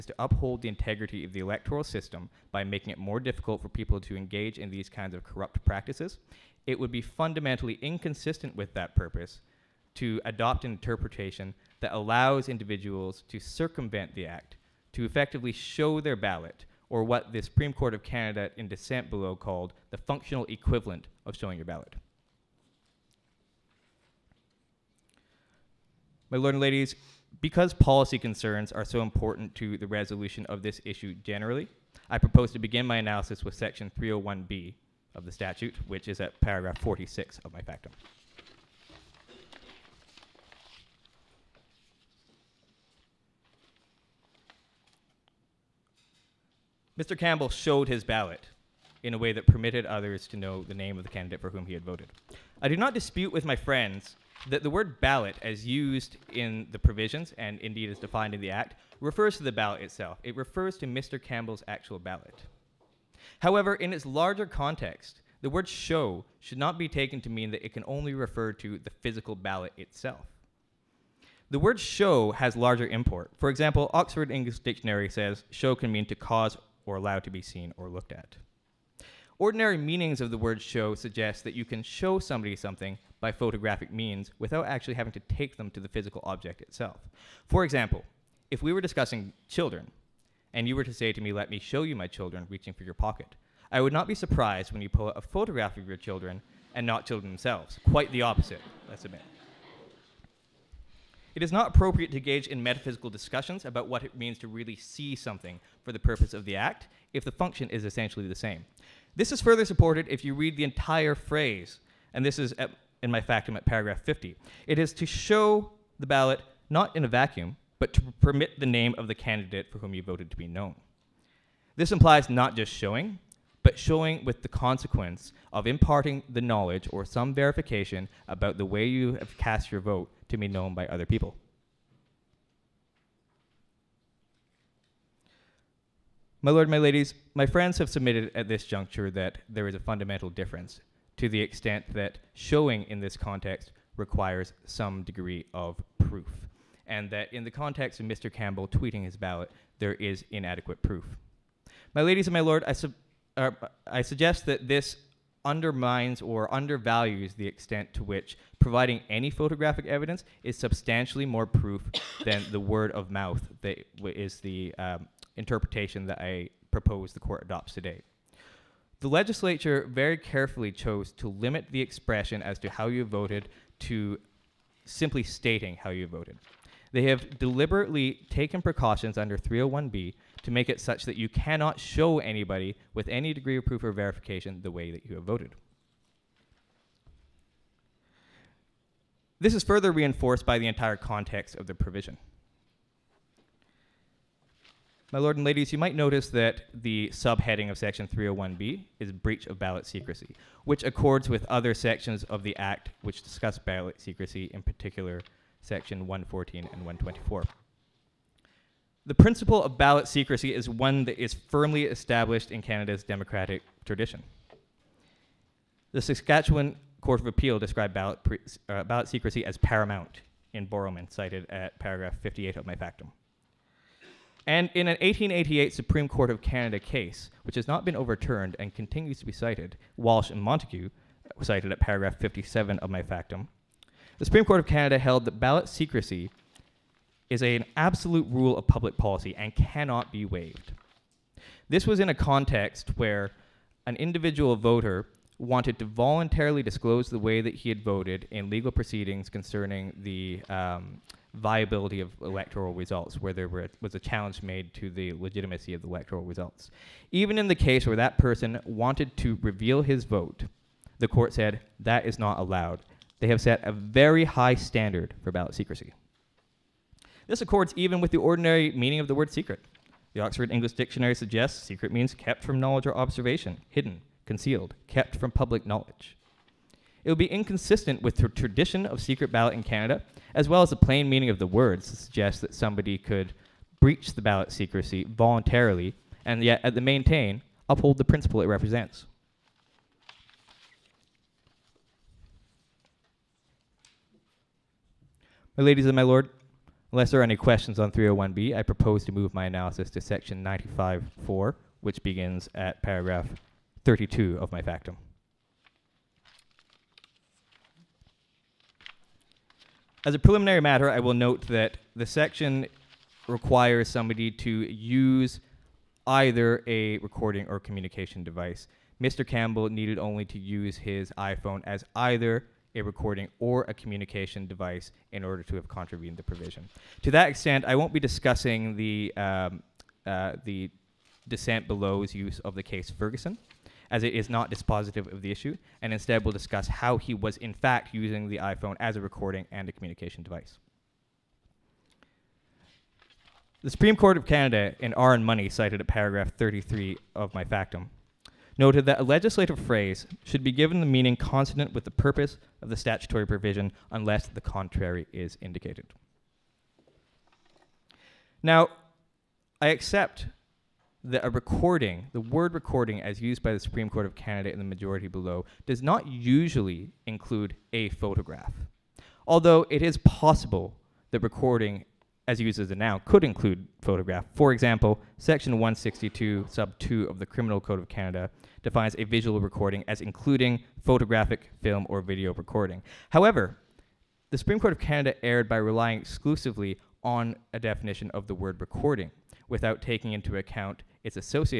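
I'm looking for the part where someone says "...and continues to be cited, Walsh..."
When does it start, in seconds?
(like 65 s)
228 s.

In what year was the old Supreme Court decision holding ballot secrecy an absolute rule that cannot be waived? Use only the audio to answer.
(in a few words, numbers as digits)
1888.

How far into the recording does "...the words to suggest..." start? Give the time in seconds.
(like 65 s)
281 s.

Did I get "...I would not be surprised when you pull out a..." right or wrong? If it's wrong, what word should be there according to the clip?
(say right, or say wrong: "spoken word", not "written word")
right.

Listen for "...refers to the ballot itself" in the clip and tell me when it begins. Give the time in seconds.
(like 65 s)
58 s.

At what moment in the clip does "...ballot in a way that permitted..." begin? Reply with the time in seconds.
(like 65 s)
48 s.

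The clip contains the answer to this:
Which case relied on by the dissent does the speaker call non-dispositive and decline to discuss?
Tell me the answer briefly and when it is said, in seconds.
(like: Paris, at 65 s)
Ferguson, at 332 s.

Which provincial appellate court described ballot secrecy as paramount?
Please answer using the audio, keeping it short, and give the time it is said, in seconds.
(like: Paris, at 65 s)
Saskatchewan Court of Appeal, at 216 s.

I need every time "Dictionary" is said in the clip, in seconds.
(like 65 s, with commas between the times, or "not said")
74 s, 270 s.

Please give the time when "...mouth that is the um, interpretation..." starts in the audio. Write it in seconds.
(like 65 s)
163 s.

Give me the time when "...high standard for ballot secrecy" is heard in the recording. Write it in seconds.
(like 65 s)
264 s.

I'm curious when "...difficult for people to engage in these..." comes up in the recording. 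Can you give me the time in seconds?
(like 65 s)
3 s.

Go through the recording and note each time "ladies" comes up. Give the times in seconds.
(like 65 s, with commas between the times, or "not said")
26 s, 136 s, 152 s, 195 s, 295 s.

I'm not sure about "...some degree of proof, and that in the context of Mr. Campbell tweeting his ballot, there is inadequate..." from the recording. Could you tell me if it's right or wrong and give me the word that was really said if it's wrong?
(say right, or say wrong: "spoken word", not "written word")
right.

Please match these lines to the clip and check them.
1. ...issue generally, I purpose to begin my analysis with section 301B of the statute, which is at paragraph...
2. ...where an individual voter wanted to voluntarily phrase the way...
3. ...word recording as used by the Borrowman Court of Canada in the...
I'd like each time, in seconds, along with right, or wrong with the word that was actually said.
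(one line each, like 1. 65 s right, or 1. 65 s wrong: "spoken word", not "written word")
1. 30 s wrong: "propose", not "purpose"
2. 242 s wrong: "disclose", not "phrase"
3. 362 s wrong: "Supreme", not "Borrowman".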